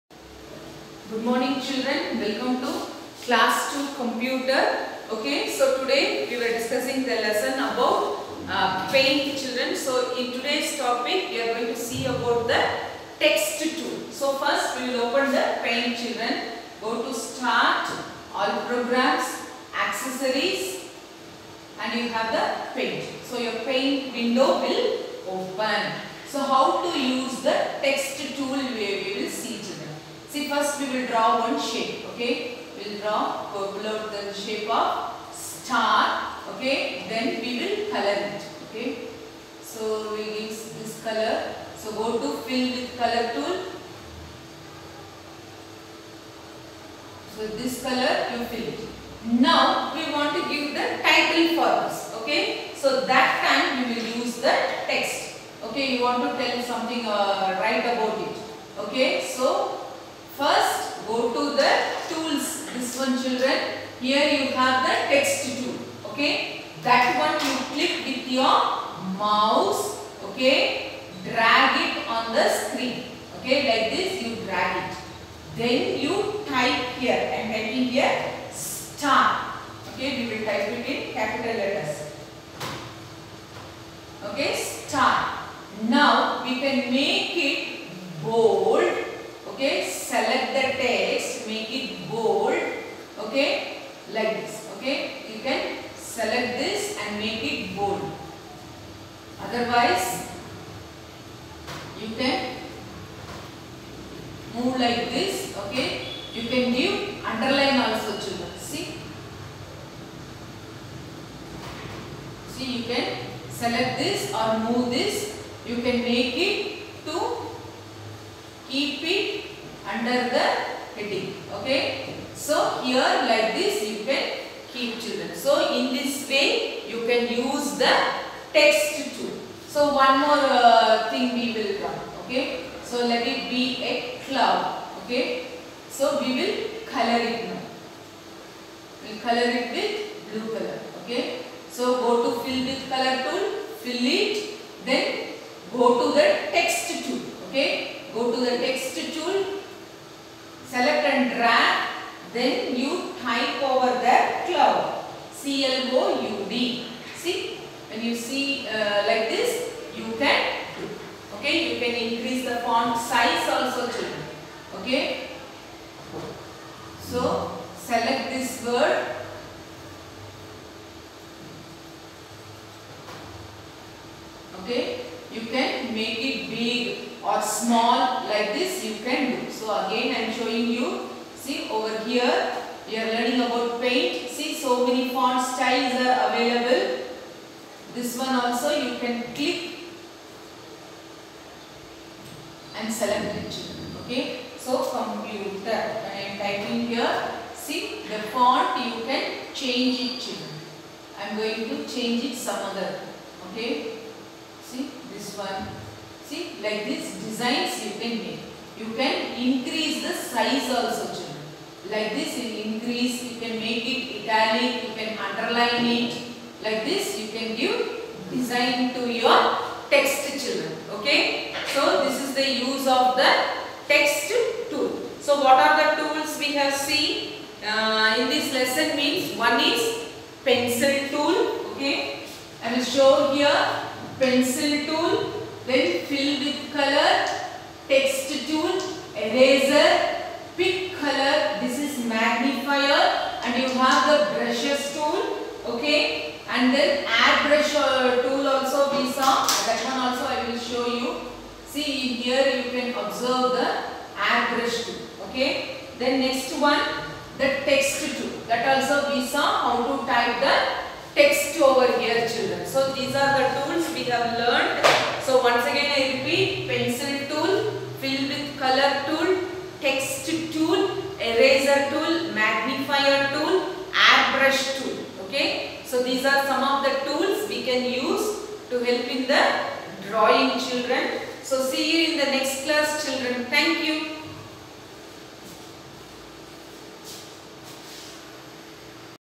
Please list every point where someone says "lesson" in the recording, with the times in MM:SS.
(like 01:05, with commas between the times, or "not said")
00:07, 03:48.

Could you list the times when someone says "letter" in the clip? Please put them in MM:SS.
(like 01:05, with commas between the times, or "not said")
01:21.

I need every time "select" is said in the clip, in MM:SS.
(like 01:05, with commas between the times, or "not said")
01:53, 02:30, 02:47, 03:12.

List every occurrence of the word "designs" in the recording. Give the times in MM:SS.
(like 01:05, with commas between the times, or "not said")
03:27, 03:38.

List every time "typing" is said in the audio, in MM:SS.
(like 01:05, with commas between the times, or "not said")
01:17, 03:16.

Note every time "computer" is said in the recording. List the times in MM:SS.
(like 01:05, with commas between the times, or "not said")
00:03, 03:14.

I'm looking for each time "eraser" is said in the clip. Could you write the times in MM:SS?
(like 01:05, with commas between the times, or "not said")
03:59, 04:31.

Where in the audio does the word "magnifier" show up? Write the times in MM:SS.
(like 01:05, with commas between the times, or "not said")
04:02, 04:32.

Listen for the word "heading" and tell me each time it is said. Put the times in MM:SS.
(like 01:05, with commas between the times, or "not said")
02:00.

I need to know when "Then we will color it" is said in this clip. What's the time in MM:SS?
00:37.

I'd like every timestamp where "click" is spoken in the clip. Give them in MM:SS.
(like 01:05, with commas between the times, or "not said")
01:07, 03:09.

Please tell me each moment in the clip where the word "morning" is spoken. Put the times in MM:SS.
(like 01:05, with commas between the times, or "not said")
00:01.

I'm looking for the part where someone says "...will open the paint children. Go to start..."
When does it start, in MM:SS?
00:14.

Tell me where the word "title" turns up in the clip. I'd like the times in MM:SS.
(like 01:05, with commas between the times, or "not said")
00:51.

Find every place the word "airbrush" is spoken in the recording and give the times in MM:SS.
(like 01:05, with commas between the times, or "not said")
04:07, 04:33.